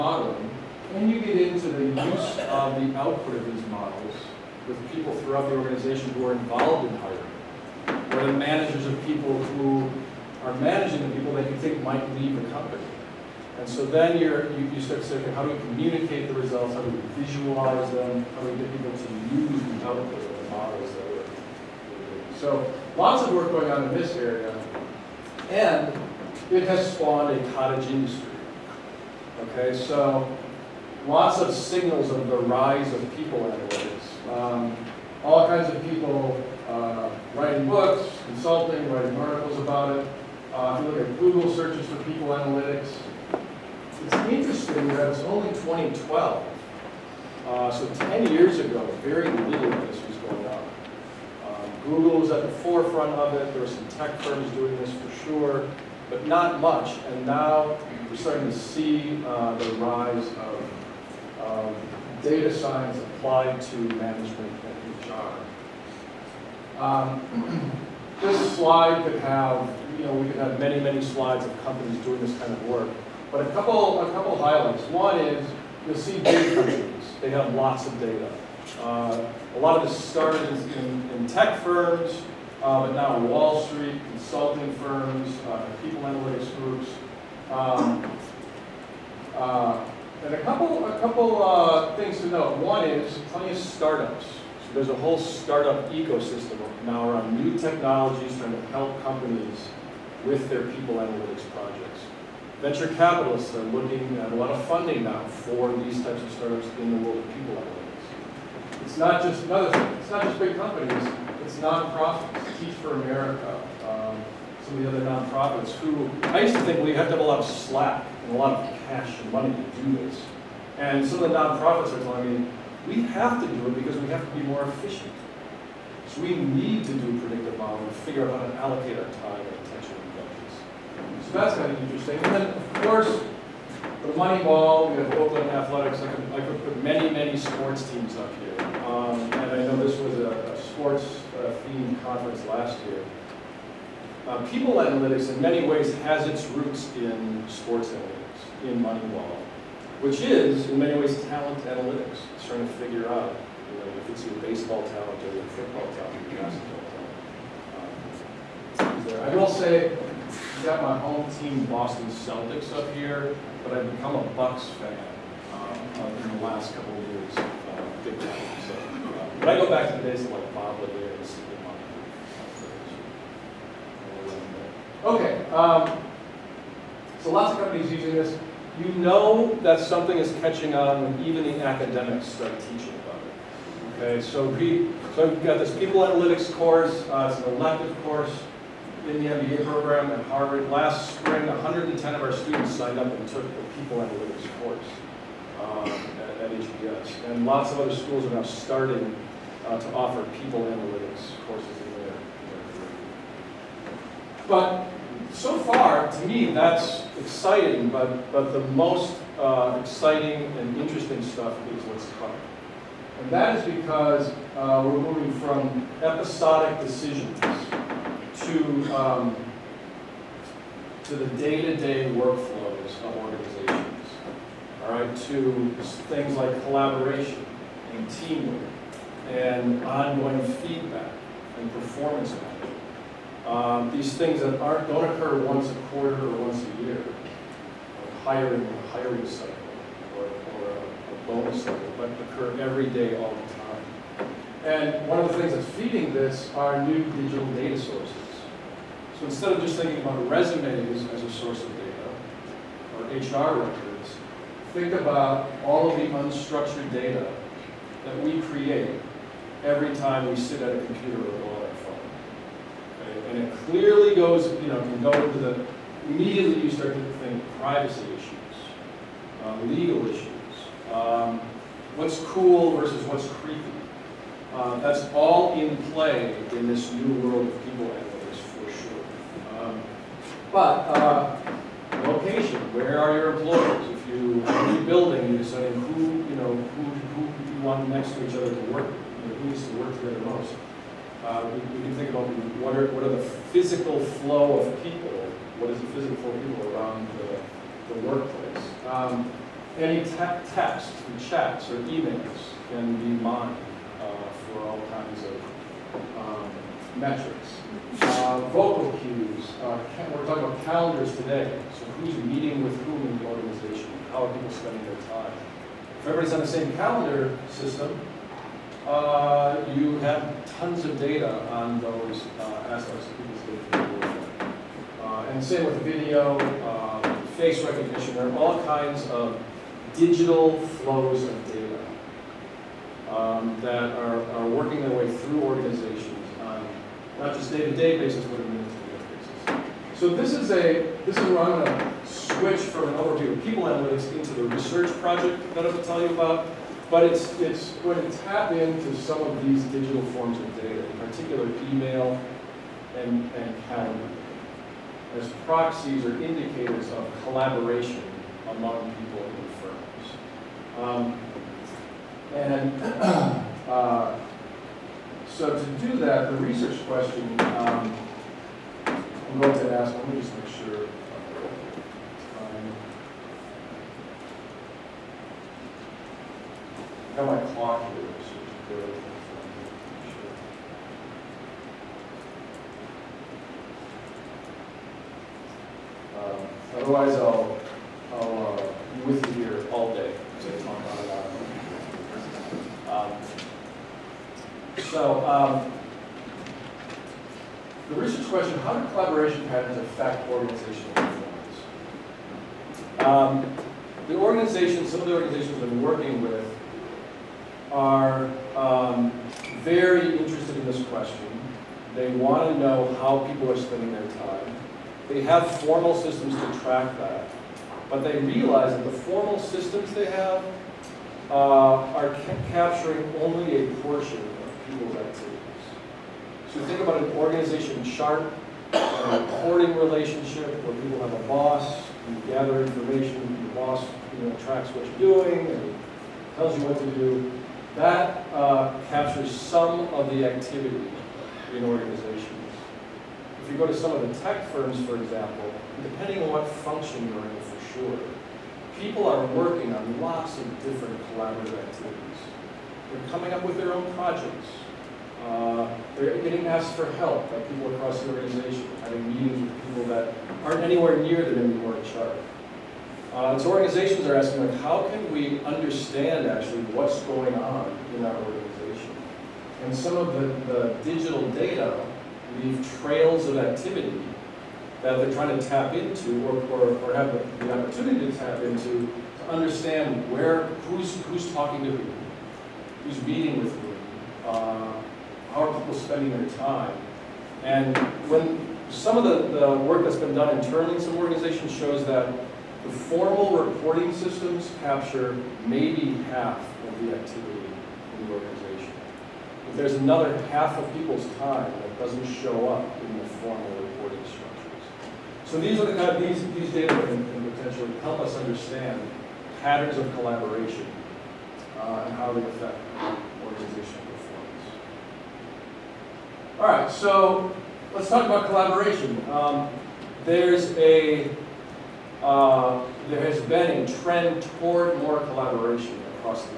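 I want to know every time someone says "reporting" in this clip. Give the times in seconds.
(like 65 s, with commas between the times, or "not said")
429 s, 493 s, 503 s.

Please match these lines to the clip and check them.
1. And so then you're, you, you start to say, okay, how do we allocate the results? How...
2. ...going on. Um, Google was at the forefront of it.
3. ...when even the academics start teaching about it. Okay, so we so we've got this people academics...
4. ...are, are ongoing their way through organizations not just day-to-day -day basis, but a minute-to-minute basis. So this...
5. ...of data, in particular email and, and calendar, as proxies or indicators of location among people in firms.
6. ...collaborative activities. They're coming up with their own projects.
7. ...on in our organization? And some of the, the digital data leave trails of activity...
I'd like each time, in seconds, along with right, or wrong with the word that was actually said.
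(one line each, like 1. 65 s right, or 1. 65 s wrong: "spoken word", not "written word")
1. 13 s wrong: "communicate", not "allocate"
2. 50 s right
3. 181 s wrong: "analytics", not "academics"
4. 333 s wrong: "working", not "ongoing"
5. 350 s wrong: "collaboration", not "location"
6. 451 s right
7. 467 s right.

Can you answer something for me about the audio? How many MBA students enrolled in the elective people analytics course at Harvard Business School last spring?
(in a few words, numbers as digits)
110.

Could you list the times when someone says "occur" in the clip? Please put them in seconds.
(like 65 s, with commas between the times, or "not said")
235 s, 242 s.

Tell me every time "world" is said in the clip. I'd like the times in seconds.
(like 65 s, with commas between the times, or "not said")
107 s, 277 s.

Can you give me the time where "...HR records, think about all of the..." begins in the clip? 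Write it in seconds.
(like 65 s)
253 s.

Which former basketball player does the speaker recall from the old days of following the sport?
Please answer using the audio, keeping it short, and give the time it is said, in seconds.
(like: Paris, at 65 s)
Bob Lanier, at 170 s.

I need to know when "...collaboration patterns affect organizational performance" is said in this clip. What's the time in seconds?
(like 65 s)
398 s.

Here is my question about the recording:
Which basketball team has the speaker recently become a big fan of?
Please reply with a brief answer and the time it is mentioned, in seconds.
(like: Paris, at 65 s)
Bucks, at 164 s.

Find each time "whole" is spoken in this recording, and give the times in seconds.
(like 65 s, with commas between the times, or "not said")
94 s.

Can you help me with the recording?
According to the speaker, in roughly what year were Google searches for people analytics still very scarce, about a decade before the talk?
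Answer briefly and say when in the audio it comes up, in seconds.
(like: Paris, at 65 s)
2012, at 45 s.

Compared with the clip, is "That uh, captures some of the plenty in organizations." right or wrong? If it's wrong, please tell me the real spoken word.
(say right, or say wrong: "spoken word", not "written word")
wrong: "activity", not "plenty".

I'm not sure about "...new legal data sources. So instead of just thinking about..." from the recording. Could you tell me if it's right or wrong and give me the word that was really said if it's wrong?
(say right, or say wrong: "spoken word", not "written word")
wrong: "digital", not "legal".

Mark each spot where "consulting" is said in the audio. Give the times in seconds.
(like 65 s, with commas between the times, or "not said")
38 s, 84 s.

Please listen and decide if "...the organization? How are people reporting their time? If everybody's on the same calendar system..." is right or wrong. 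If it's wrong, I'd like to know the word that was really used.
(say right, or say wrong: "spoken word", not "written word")
wrong: "spending", not "reporting".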